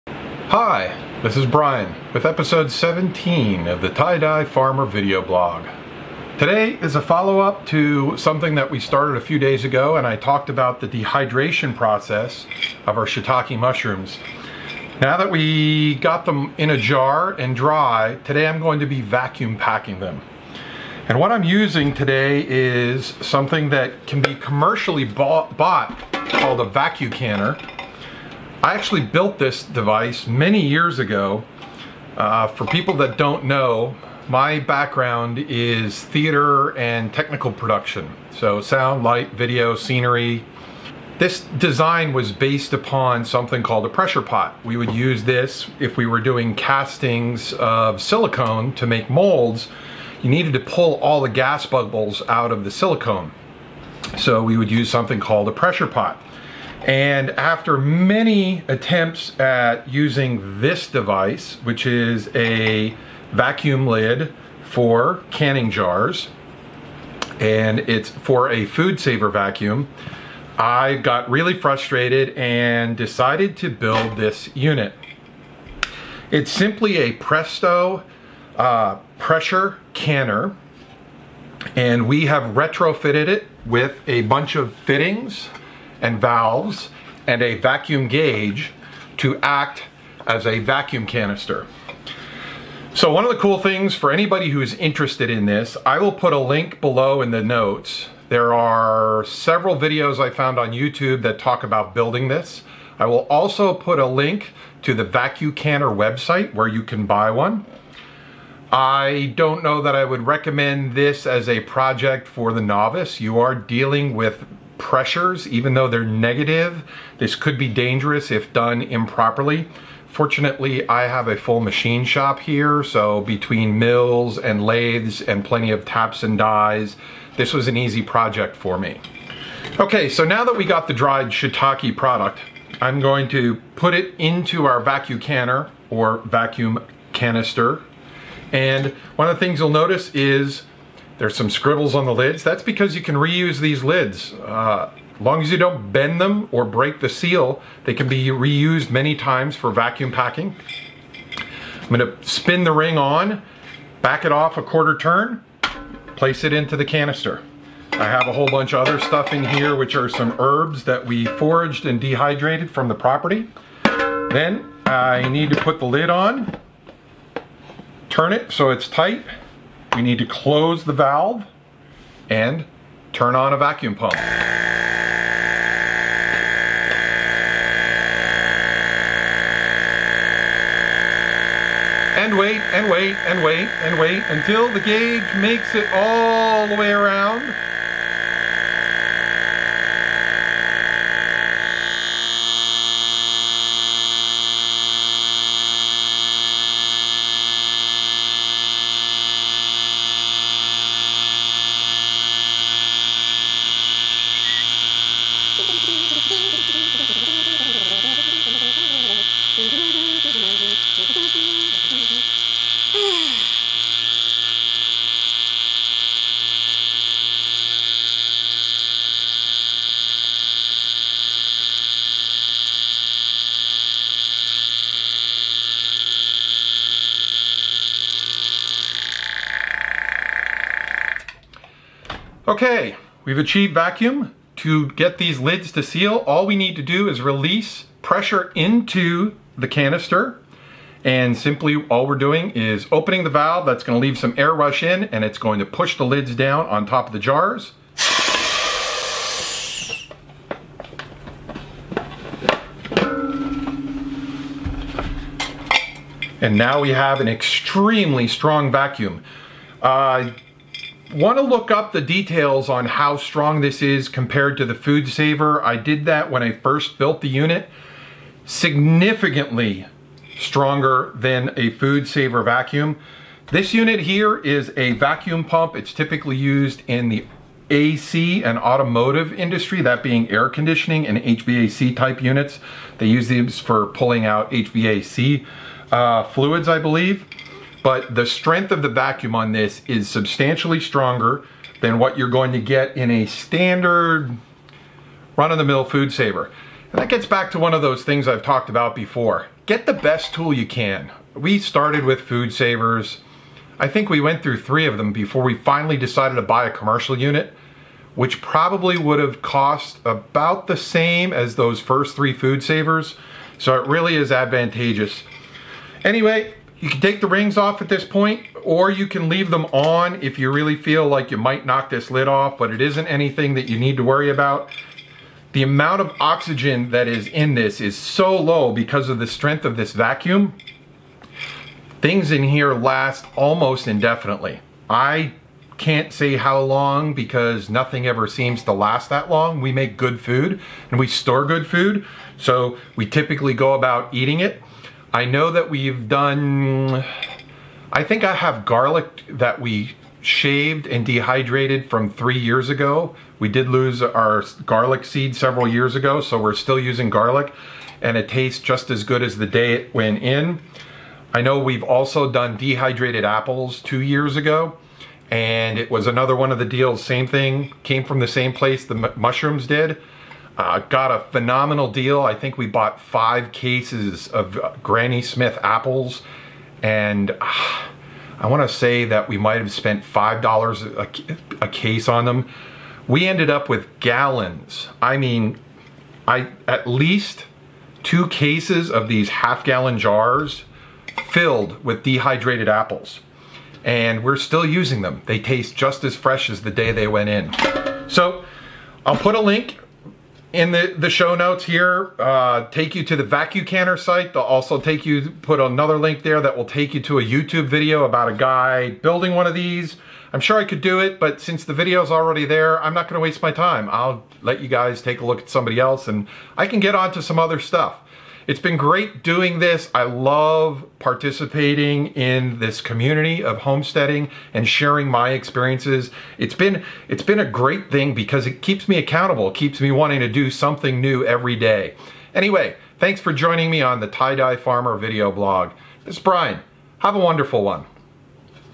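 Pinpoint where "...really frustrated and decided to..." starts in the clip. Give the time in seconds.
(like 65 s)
71 s.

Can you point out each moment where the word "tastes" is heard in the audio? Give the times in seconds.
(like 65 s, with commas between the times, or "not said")
358 s, 395 s.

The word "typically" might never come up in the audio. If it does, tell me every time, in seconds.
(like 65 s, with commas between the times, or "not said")
275 s, 343 s.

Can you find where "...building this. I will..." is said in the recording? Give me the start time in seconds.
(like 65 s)
101 s.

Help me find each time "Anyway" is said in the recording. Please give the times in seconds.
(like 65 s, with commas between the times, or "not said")
316 s, 432 s.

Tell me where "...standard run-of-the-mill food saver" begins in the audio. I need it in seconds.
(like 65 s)
293 s.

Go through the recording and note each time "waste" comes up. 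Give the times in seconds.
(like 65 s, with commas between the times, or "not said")
413 s.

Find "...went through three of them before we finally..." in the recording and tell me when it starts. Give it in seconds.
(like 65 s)
304 s.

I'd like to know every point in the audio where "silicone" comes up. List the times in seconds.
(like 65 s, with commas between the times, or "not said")
47 s, 52 s.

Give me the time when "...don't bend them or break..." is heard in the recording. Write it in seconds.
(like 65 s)
145 s.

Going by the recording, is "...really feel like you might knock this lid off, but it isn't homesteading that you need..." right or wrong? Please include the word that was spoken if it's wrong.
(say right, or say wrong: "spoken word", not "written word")
wrong: "anything", not "homesteading".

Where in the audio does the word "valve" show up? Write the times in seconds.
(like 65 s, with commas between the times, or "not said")
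86 s, 170 s, 243 s.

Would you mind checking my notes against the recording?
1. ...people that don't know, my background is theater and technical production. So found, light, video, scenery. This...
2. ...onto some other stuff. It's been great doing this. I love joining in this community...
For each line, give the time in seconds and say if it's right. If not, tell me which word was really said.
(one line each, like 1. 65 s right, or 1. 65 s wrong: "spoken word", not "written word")
1. 32 s wrong: "sound", not "found"
2. 416 s wrong: "participating", not "joining".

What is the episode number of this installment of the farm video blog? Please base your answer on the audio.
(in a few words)
17.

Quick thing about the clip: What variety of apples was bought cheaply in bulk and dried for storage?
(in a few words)
Granny Smith.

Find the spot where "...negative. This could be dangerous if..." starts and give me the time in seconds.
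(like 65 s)
116 s.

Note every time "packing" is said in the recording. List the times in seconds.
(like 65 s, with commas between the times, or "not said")
19 s, 150 s.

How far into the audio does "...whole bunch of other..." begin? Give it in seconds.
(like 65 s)
158 s.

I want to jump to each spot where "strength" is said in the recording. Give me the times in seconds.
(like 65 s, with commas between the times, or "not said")
288 s, 329 s.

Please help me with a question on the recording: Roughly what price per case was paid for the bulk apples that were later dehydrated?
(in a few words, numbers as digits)
$5.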